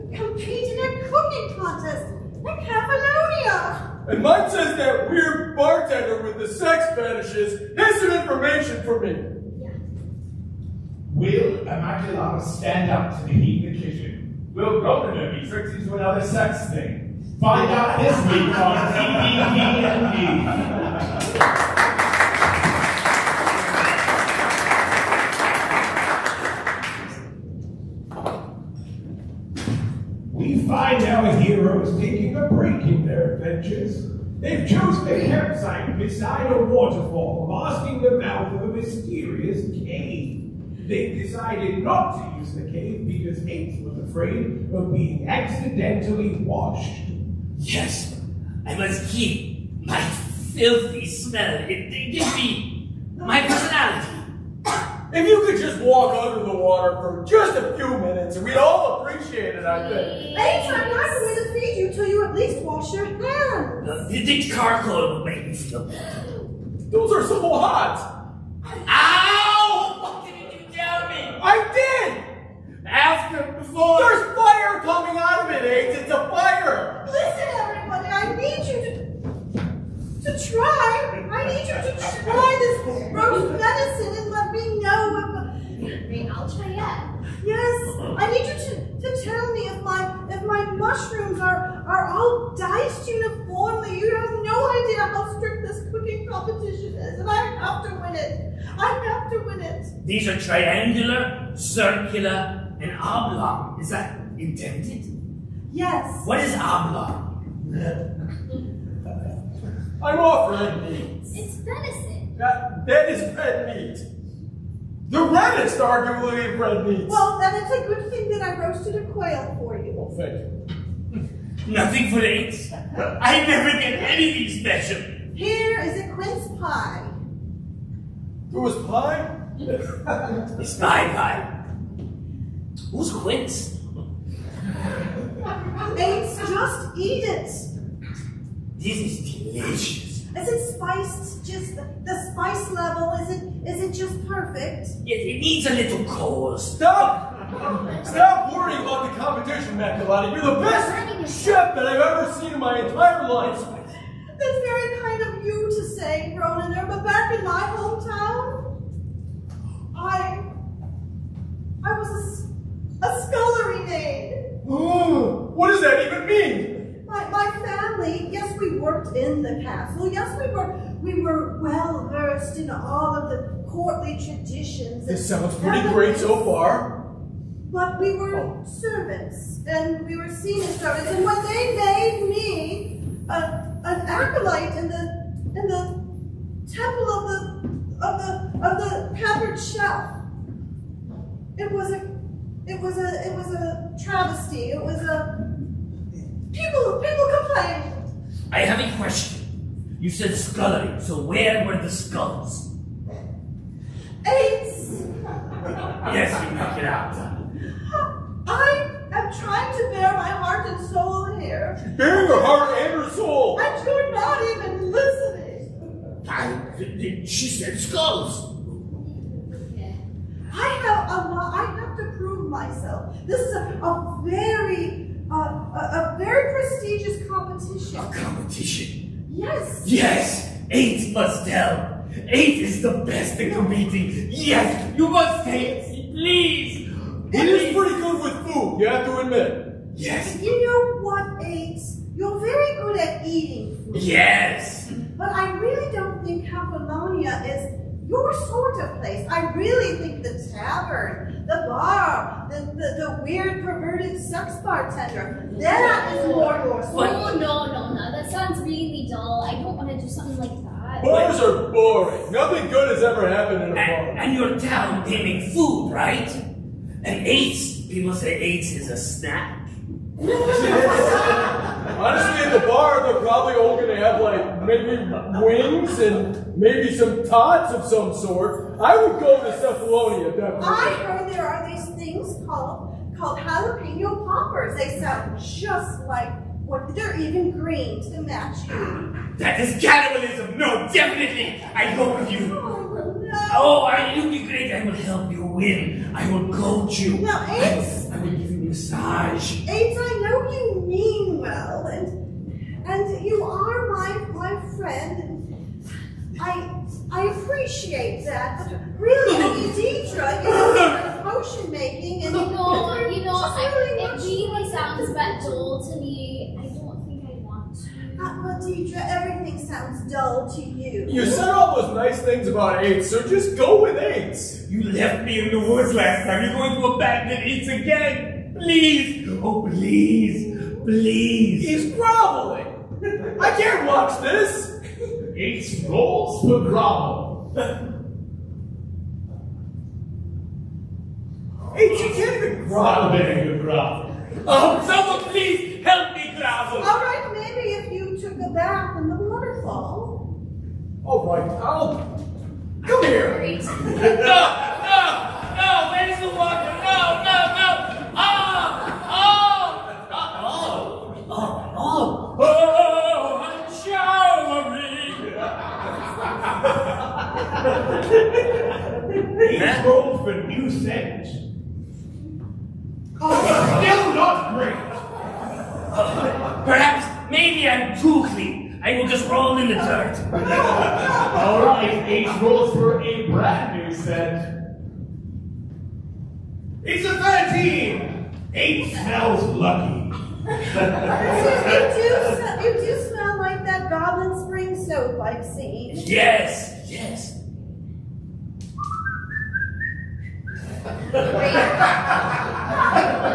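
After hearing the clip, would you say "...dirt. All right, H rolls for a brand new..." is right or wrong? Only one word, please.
right.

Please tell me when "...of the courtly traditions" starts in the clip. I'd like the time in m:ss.
2:53.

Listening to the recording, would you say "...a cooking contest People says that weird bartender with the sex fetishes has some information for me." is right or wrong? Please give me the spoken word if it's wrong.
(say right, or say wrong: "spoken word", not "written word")
wrong: "And", not "People".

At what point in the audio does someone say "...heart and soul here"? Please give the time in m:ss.
3:30.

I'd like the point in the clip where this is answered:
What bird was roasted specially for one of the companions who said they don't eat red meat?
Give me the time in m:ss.
1:59.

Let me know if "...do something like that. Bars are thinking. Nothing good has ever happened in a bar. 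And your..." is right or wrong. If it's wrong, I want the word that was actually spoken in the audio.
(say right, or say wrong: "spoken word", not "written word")
wrong: "boring", not "thinking".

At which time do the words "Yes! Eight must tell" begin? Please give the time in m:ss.
3:49.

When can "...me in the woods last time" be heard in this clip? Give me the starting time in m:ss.
5:25.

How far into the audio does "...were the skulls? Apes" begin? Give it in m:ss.
3:21.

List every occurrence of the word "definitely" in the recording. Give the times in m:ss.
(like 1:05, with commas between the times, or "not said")
4:40, 4:50.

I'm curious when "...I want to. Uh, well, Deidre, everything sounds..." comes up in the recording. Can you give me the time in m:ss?
5:17.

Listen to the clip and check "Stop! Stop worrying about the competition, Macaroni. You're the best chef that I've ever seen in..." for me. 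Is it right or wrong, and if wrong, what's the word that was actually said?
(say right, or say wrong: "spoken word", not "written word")
right.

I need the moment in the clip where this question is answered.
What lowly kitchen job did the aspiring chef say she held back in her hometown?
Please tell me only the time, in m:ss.
2:43.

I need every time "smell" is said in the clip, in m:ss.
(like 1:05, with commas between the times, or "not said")
0:51, 6:28, 6:33.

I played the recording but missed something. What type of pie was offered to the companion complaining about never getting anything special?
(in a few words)
Quince pie.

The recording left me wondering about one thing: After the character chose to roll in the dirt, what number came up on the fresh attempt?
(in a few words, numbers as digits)
13.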